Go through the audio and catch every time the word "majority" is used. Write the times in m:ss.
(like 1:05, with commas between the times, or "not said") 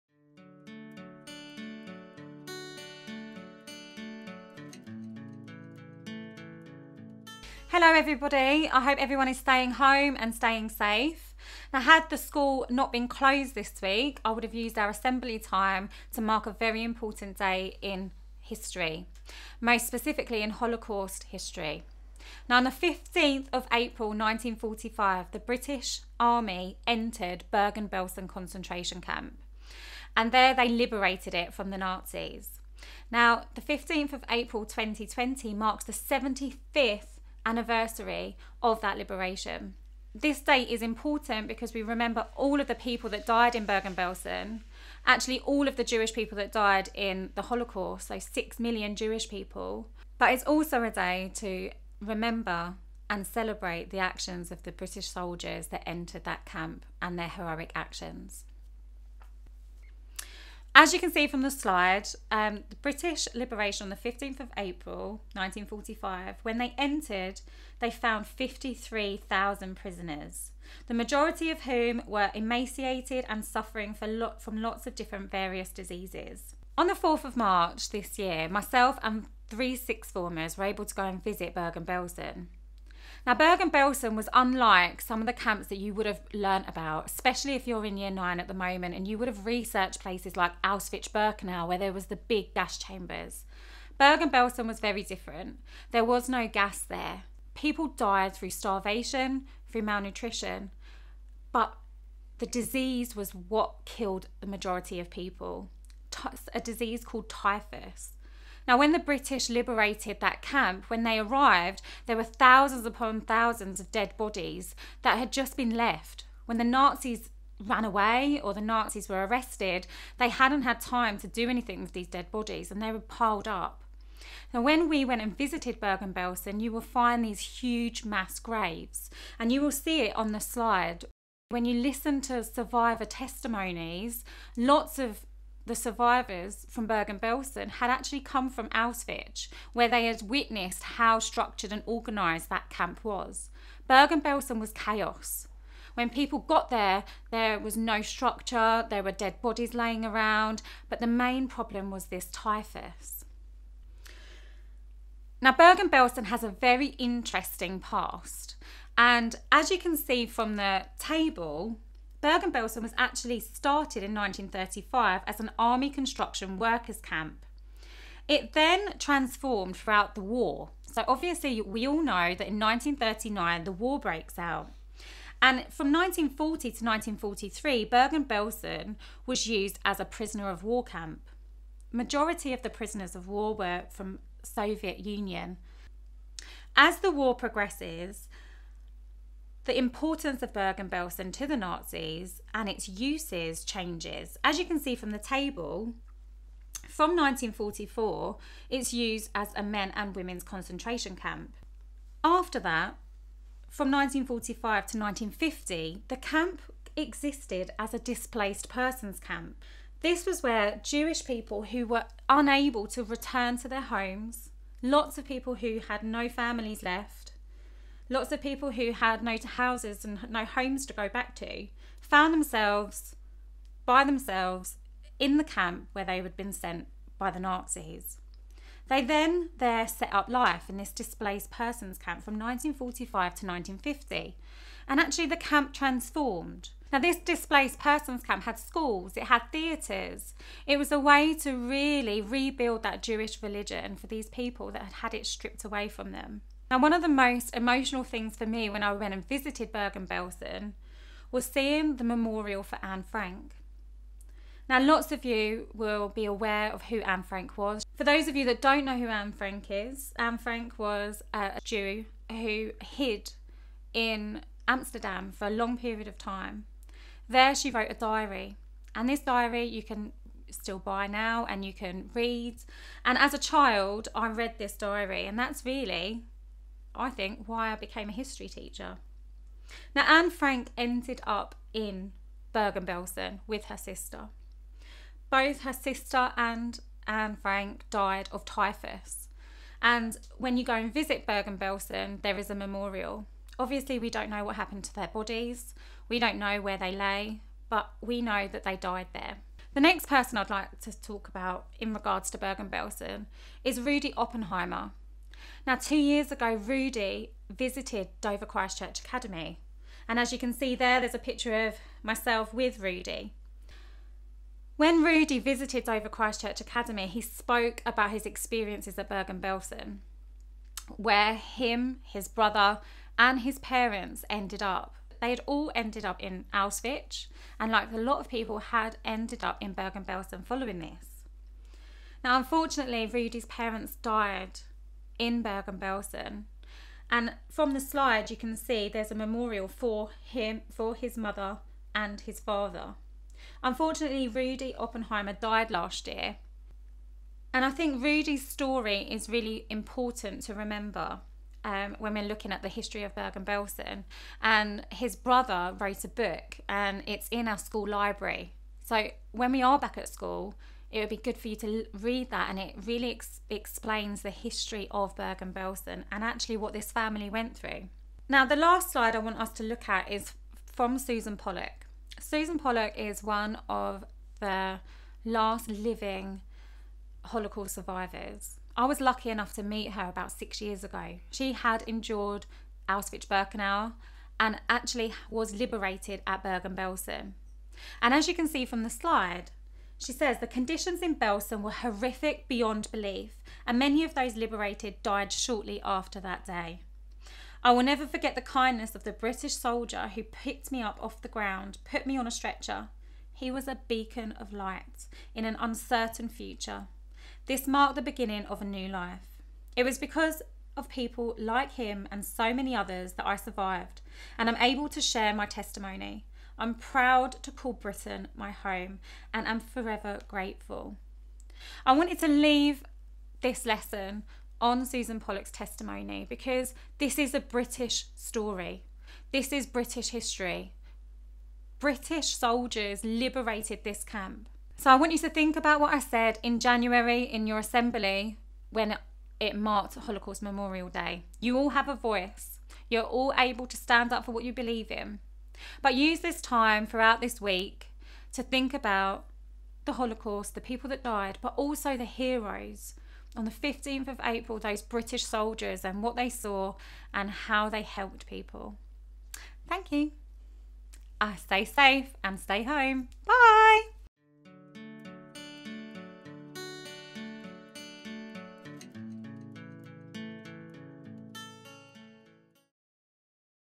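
1:10, 1:44, 3:01.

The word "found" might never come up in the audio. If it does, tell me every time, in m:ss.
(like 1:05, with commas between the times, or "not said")
1:07, 3:42.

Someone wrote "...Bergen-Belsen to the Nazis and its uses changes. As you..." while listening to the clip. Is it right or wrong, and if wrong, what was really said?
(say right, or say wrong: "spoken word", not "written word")
right.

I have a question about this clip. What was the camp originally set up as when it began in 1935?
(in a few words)
Army construction workers' camp.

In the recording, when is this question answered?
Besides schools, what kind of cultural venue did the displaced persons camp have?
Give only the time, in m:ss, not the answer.
3:59.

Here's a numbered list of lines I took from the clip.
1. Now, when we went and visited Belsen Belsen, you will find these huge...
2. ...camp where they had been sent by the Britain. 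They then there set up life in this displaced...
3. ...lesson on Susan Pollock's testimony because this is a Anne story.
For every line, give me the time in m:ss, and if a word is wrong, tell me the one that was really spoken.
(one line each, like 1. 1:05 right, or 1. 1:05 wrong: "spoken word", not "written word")
1. 2:04 wrong: "Bergen", not "Belsen"
2. 3:45 wrong: "Nazis", not "Britain"
3. 7:03 wrong: "British", not "Anne".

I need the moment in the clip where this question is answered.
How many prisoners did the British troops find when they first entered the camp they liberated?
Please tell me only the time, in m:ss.
1:08.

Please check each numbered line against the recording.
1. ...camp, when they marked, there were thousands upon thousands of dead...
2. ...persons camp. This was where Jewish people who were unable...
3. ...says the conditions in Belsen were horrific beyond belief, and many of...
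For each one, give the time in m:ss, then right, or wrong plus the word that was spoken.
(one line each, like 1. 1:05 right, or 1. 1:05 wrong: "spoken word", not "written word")
1. 1:50 wrong: "arrived", not "marked"
2. 3:28 right
3. 6:30 right.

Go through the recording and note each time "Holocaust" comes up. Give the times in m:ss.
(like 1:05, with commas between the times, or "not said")
0:20, 0:47, 6:17, 7:19, 7:29.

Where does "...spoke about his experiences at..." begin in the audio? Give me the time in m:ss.
5:17.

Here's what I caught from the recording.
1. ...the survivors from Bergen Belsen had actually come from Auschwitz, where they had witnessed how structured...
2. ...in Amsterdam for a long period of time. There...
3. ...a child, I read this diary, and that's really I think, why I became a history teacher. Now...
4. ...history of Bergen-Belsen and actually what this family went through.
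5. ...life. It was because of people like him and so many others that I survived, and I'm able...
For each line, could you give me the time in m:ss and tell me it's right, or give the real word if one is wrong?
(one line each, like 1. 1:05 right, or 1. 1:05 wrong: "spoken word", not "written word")
1. 2:15 right
2. 4:23 right
3. 4:33 right
4. 6:04 right
5. 6:48 right.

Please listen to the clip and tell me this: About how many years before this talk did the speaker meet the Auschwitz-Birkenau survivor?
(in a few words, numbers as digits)
6.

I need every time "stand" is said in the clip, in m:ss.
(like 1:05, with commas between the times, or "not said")
7:23.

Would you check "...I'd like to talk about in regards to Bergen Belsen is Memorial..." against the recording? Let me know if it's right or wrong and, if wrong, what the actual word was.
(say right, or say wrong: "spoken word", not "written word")
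wrong: "Rudi", not "Memorial".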